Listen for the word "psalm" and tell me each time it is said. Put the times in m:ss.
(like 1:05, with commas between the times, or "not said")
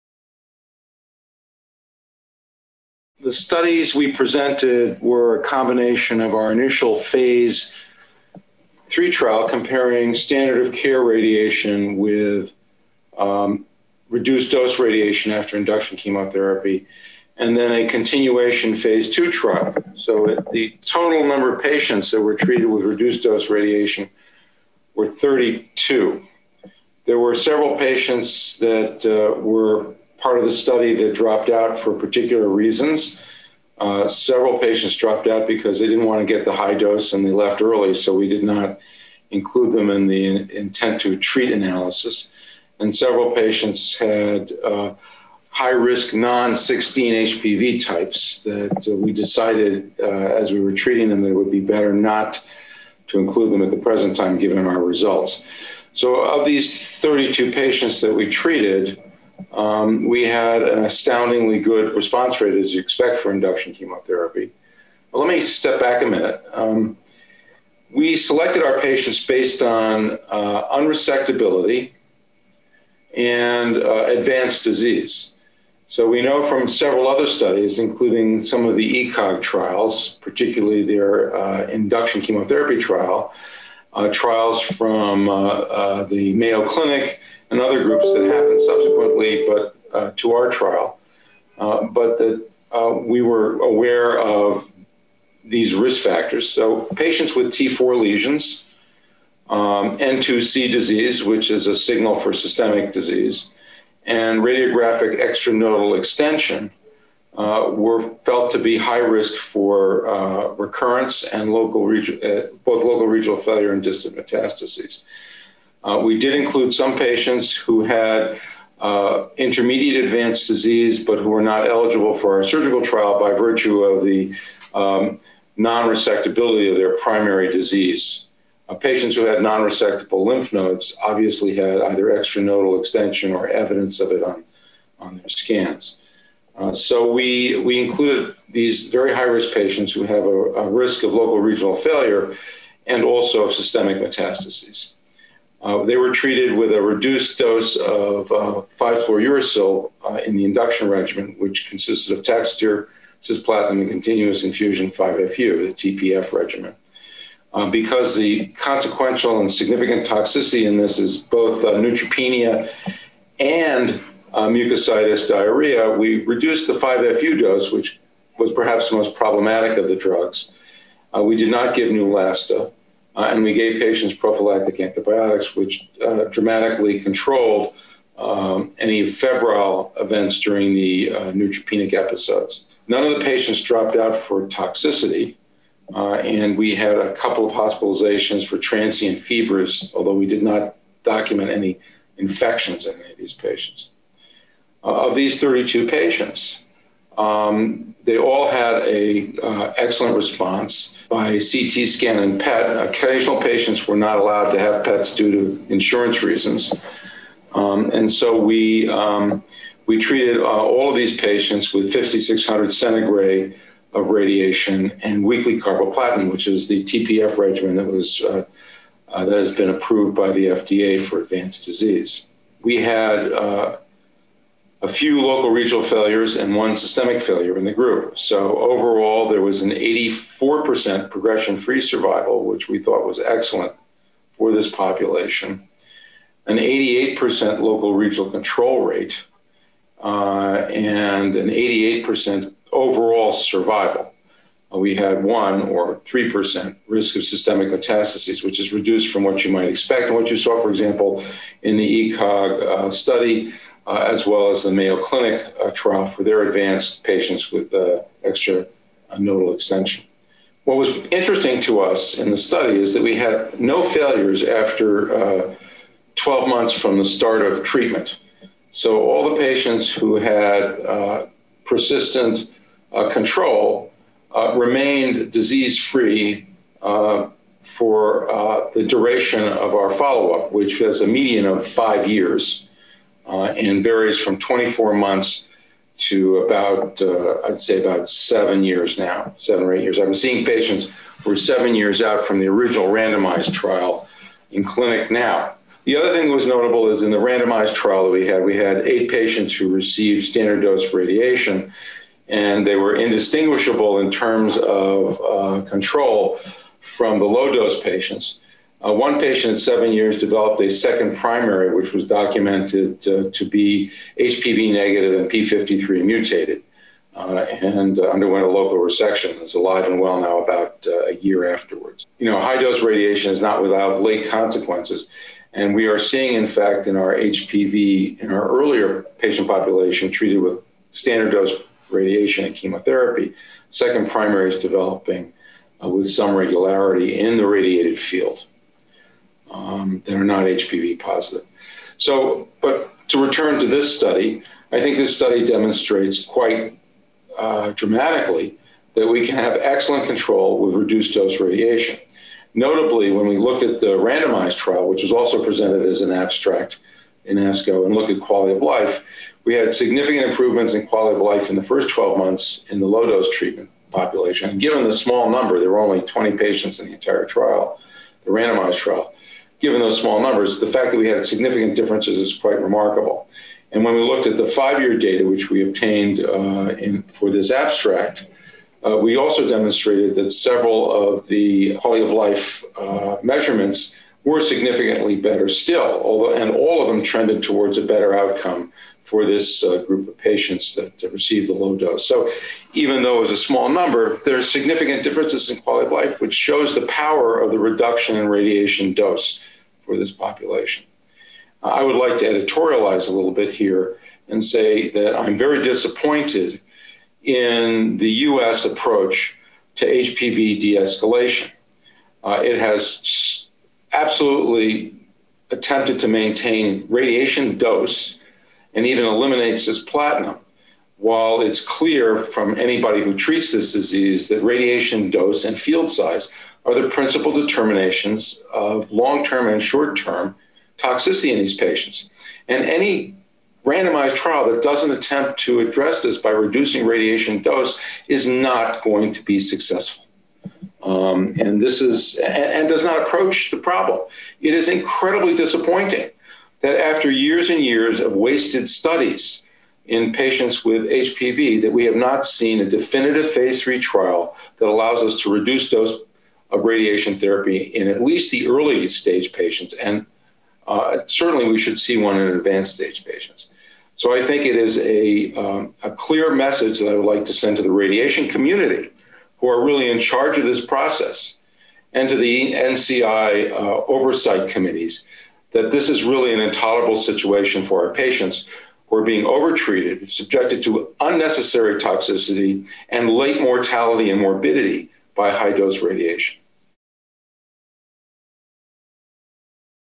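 not said.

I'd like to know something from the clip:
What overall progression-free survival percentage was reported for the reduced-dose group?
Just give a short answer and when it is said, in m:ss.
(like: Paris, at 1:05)
84%, at 3:49.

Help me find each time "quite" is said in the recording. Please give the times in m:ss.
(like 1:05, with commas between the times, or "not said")
5:46, 6:12.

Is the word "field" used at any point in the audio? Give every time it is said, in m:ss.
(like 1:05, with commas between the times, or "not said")
5:37, 7:05.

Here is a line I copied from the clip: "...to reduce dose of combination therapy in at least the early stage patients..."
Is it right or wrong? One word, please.
wrong.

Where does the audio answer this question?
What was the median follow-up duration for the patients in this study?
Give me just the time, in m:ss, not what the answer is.
4:41.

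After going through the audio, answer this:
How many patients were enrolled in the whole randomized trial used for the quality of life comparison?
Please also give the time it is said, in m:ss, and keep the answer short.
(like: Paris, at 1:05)
20, at 6:06.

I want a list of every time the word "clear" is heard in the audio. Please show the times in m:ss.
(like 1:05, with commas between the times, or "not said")
7:01, 7:45.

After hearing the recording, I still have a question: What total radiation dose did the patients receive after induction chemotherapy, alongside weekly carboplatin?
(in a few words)
5,600 centigray.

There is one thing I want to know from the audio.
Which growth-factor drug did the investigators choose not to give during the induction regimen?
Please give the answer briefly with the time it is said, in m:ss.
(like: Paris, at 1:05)
Neulasta, at 2:51.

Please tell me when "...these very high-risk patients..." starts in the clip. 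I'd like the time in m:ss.
2:18.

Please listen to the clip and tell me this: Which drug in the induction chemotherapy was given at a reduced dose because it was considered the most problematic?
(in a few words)
5-fluorouracil.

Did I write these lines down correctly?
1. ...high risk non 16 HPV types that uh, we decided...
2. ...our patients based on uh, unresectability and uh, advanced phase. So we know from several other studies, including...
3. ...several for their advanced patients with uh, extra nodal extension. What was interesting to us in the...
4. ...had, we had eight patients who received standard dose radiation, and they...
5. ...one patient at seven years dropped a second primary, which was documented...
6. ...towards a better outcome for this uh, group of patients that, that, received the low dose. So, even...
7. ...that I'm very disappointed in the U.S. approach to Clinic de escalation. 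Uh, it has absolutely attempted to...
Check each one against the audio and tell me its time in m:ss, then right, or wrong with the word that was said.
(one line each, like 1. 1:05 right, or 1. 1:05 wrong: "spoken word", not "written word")
1. 0:45 right
2. 1:08 wrong: "disease", not "phase"
3. 4:15 wrong: "trial", not "several"
4. 4:58 right
5. 5:08 wrong: "developed", not "dropped"
6. 6:27 right
7. 6:44 wrong: "HPV", not "Clinic".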